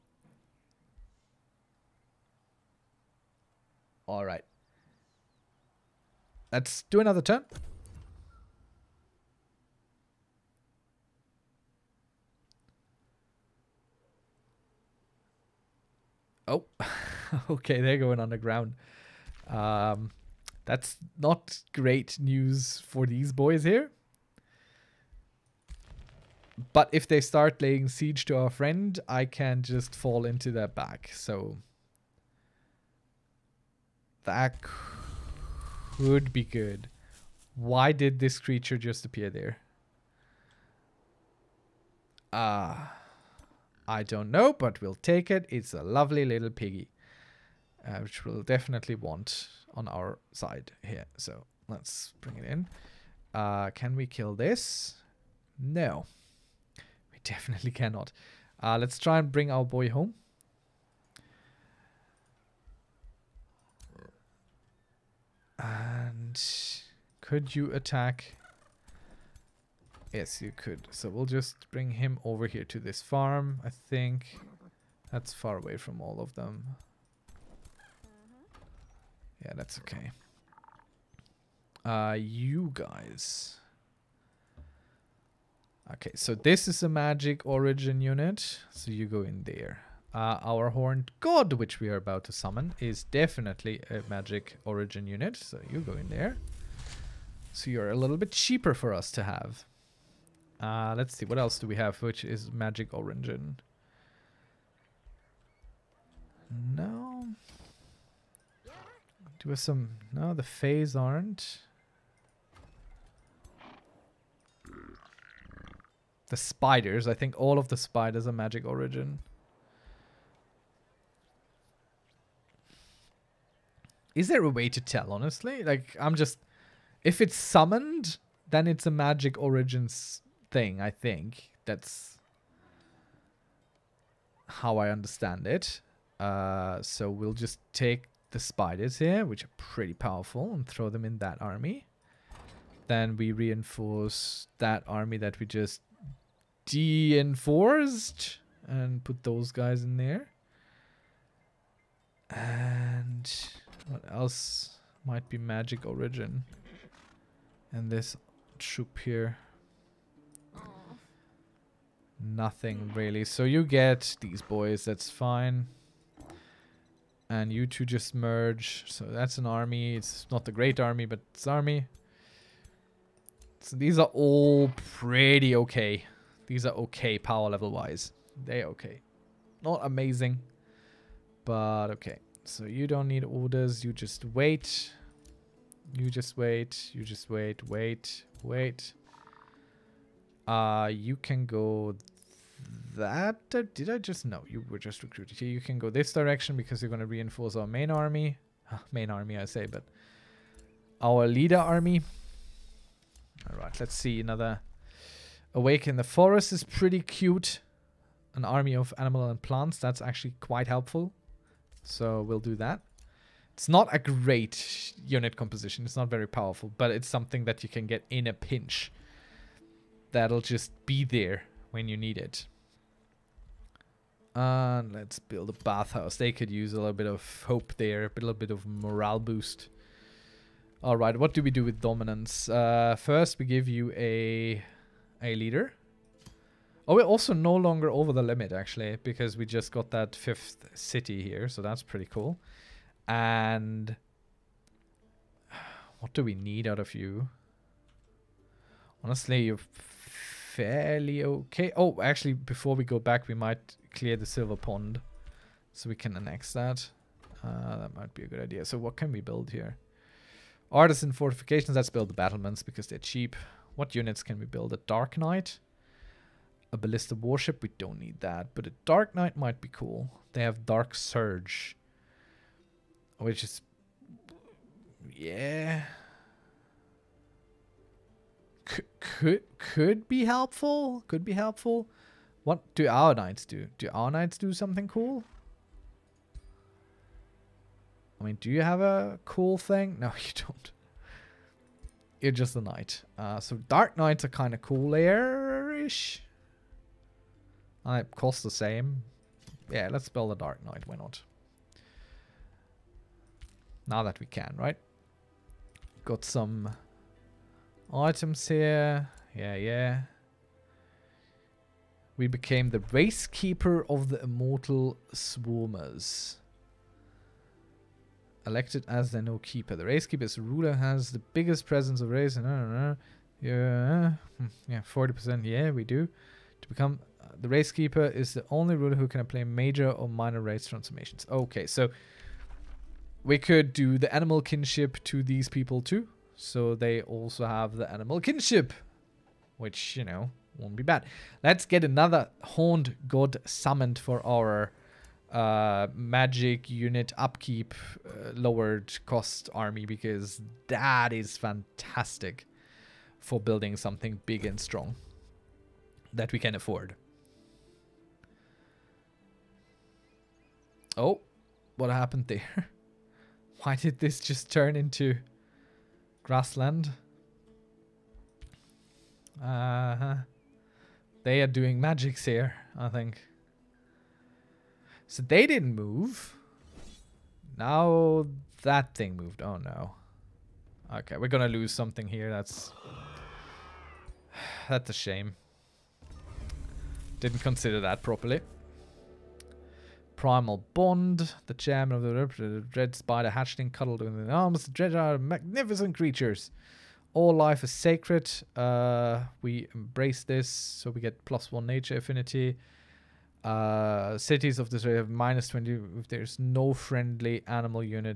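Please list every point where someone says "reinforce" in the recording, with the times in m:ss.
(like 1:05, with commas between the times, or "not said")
2:23, 3:17.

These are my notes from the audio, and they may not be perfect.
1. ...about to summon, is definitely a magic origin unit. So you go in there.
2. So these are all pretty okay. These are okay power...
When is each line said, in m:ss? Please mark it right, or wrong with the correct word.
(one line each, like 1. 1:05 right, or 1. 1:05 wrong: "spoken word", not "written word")
1. 1:31 right
2. 2:53 right.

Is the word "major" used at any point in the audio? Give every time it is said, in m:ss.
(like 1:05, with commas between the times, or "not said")
5:29.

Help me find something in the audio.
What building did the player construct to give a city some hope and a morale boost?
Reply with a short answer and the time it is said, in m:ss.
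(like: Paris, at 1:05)
bathhouse, at 3:44.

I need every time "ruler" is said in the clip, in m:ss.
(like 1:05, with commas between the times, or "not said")
5:20, 5:28.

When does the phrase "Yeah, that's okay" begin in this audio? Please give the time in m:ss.
1:19.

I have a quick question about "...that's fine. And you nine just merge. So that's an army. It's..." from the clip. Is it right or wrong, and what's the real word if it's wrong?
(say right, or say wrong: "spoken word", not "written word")
wrong: "two", not "nine".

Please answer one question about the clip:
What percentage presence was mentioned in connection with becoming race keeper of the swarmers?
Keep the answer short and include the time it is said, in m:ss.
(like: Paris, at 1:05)
40%, at 5:24.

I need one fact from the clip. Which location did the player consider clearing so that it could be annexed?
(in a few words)
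the silver pond.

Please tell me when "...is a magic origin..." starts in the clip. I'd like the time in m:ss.
1:26.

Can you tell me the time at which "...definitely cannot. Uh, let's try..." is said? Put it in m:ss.
0:57.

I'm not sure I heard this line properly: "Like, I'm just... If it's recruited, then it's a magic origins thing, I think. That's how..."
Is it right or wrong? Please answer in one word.
wrong.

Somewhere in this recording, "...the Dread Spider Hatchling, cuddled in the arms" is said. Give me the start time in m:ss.
6:32.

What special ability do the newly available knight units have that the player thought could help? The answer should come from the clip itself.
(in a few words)
Dark Surge.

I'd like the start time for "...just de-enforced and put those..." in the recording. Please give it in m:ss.
2:25.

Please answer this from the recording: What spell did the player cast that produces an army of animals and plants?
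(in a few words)
Awaken the Forest.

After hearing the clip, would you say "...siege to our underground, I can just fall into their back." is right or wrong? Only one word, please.
wrong.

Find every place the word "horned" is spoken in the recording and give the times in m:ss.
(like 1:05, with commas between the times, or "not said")
1:30, 5:42.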